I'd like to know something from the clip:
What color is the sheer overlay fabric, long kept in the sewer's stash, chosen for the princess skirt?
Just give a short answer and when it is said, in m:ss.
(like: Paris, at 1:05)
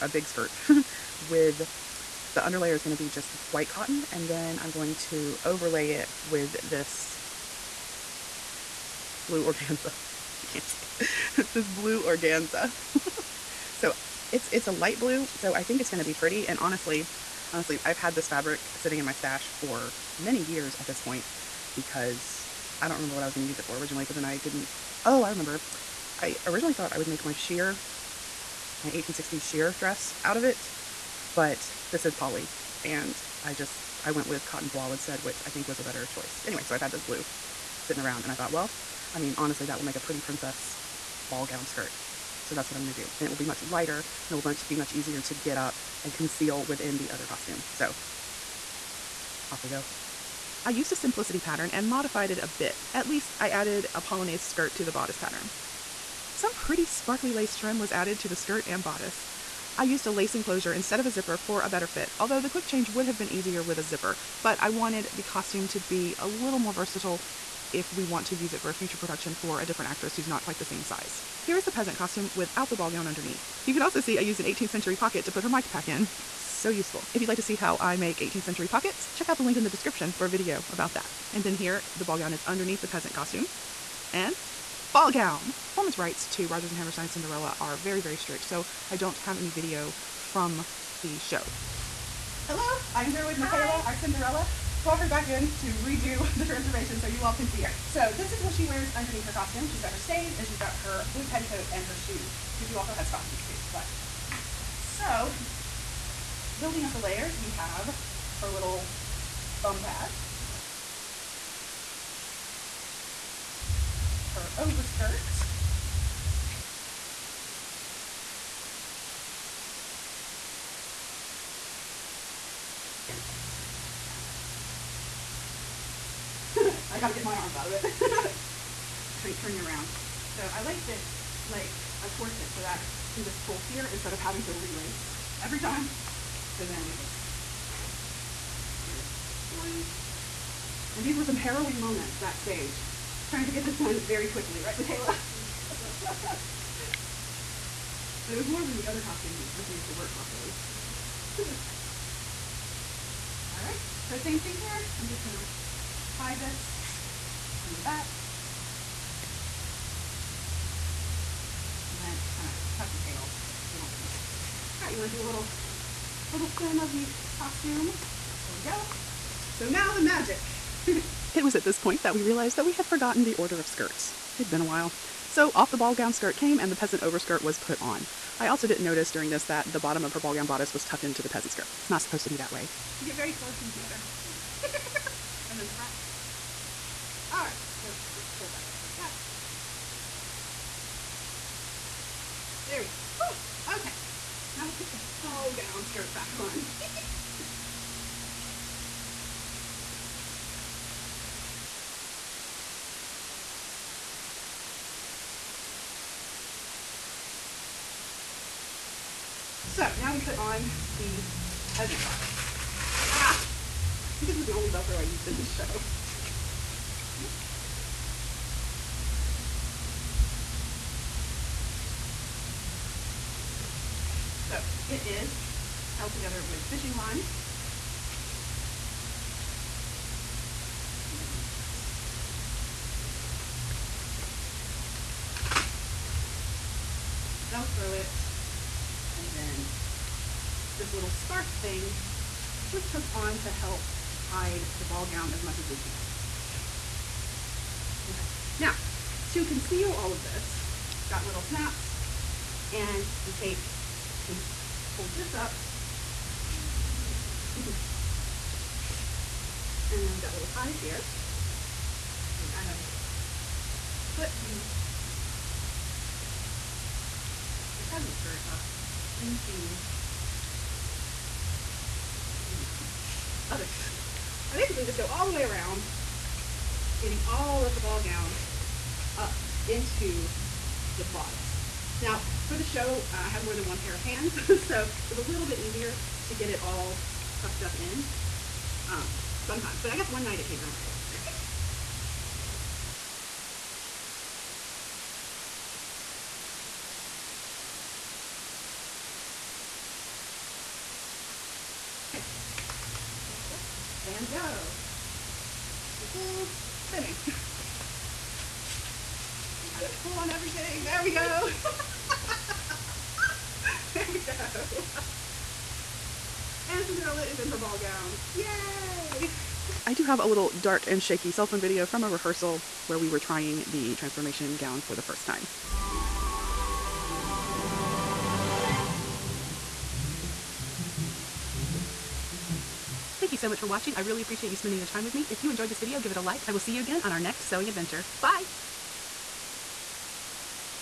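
light blue, at 0:14.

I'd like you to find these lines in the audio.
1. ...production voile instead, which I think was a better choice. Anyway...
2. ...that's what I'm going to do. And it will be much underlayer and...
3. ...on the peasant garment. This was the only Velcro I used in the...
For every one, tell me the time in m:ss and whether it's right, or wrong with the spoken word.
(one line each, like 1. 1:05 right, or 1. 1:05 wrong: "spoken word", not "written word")
1. 0:34 wrong: "cotton", not "production"
2. 0:42 wrong: "lighter", not "underlayer"
3. 3:30 right.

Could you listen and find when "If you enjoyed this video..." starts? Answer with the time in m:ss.
5:35.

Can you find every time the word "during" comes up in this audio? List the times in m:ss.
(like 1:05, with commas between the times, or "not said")
2:59.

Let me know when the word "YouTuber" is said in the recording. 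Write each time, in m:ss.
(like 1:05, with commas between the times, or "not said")
not said.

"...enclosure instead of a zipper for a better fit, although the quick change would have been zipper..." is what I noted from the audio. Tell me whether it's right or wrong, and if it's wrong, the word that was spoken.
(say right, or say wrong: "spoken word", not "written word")
wrong: "easier", not "zipper".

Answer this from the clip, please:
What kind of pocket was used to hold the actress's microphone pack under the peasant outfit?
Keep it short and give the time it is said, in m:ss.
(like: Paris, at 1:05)
18th century pocket, at 1:14.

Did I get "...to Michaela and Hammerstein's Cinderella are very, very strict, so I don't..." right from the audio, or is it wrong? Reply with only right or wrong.
wrong.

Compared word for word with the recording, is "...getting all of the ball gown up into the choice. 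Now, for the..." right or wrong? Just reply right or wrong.
wrong.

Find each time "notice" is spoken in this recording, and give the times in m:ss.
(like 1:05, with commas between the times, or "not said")
2:58.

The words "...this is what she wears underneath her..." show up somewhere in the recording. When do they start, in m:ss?
1:38.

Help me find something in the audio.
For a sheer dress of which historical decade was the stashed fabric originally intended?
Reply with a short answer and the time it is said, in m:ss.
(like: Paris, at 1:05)
1860s, at 0:28.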